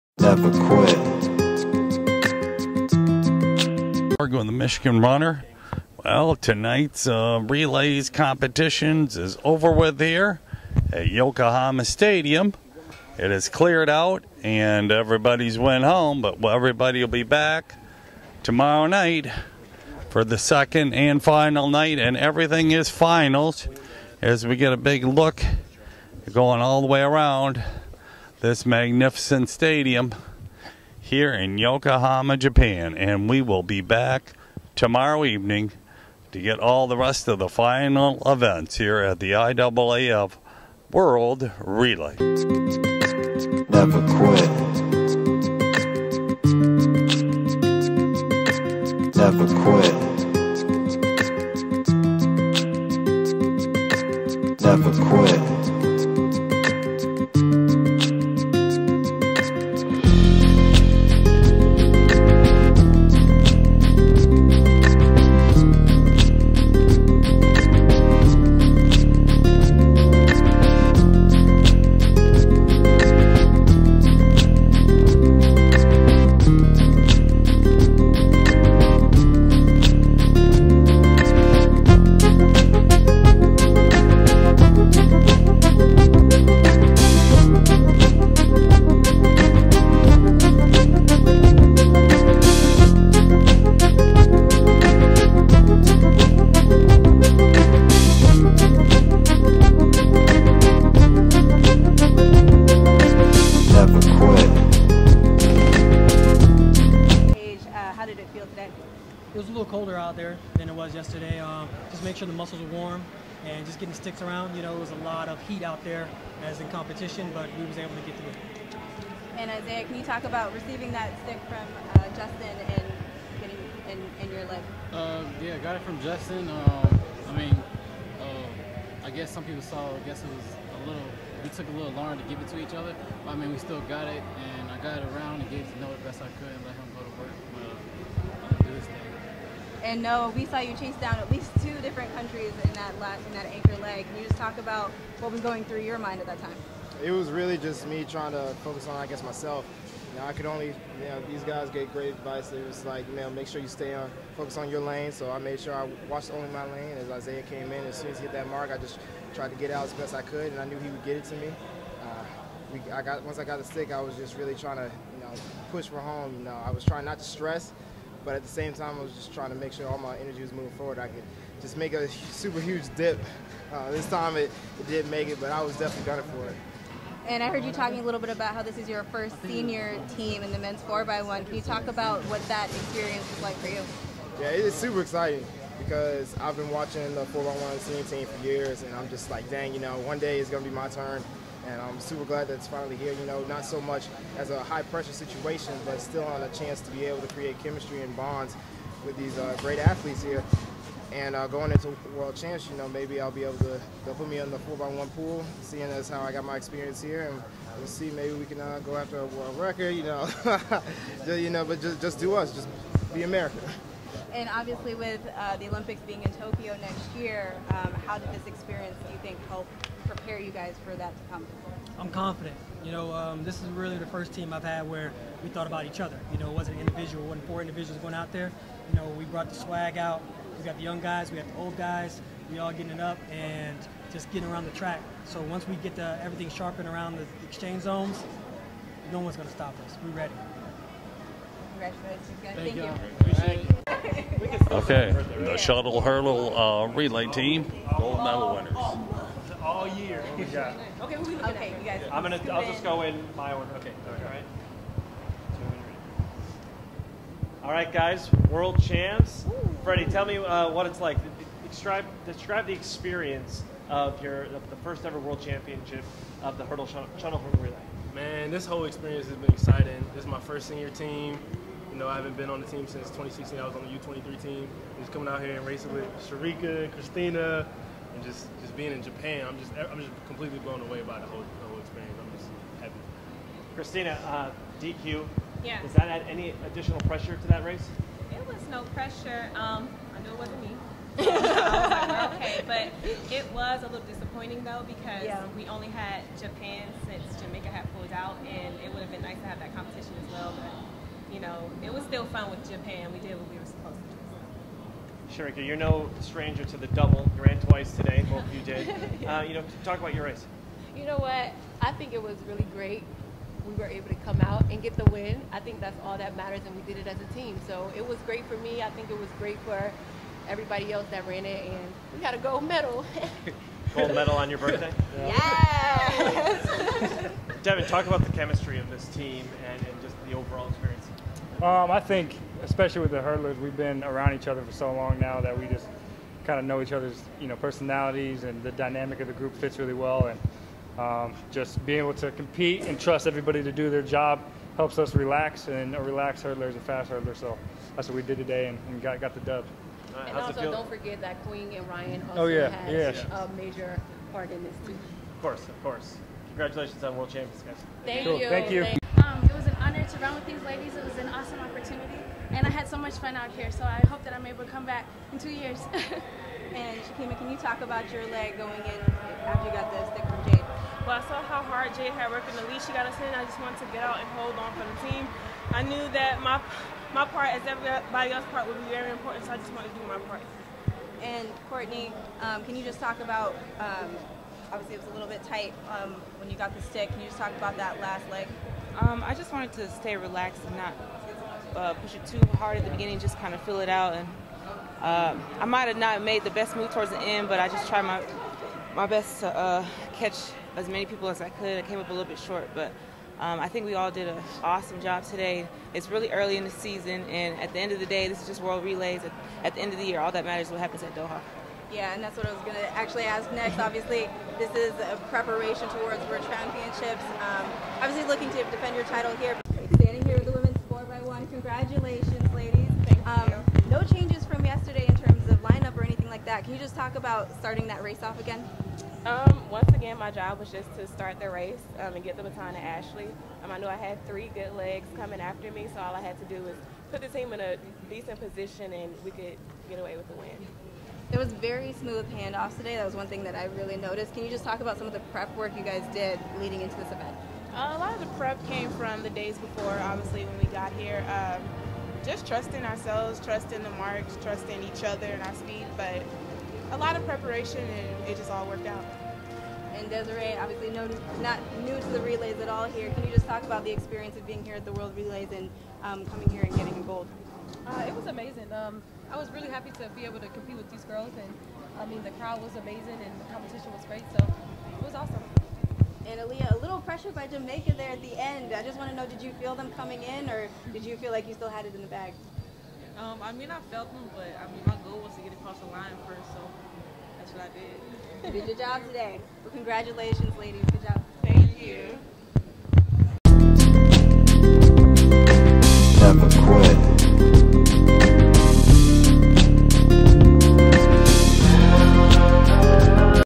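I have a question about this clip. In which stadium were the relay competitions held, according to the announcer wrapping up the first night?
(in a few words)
Yokohama Stadium.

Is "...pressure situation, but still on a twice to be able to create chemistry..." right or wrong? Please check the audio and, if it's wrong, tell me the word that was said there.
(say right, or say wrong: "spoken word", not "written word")
wrong: "chance", not "twice".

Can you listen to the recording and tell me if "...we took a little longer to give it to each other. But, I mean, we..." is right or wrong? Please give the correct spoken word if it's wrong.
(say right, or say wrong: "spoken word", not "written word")
right.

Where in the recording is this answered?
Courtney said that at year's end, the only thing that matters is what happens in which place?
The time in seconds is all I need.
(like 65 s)
411 s.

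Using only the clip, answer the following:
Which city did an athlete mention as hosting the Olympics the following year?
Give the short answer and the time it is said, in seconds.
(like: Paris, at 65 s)
Tokyo, at 216 s.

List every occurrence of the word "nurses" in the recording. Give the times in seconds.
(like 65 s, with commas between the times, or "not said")
not said.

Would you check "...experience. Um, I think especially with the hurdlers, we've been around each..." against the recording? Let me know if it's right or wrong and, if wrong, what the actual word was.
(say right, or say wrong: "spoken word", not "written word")
right.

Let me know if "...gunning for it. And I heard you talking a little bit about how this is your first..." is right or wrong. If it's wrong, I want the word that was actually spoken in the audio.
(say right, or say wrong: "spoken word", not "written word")
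right.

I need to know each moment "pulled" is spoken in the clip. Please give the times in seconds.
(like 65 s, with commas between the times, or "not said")
297 s.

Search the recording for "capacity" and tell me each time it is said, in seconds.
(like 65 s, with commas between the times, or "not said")
not said.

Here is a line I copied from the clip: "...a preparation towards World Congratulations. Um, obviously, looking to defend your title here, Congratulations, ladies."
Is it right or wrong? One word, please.
wrong.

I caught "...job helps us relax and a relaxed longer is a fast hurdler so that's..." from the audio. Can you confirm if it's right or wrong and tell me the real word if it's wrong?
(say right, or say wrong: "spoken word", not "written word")
wrong: "hurdler", not "longer".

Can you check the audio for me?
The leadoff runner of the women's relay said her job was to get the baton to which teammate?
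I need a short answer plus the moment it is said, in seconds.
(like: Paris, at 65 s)
Ashley, at 432 s.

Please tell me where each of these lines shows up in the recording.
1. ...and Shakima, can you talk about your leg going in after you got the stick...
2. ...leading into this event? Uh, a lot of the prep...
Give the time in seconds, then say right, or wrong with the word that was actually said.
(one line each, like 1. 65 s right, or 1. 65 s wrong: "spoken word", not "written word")
1. 366 s right
2. 446 s right.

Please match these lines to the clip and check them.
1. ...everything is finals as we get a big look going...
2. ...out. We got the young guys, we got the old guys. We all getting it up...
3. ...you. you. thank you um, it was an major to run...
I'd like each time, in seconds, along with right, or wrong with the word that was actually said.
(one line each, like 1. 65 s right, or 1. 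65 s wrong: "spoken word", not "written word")
1. 22 s right
2. 229 s right
3. 358 s wrong: "honor", not "major".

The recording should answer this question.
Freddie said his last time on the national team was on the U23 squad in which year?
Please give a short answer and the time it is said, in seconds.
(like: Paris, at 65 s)
2016, at 273 s.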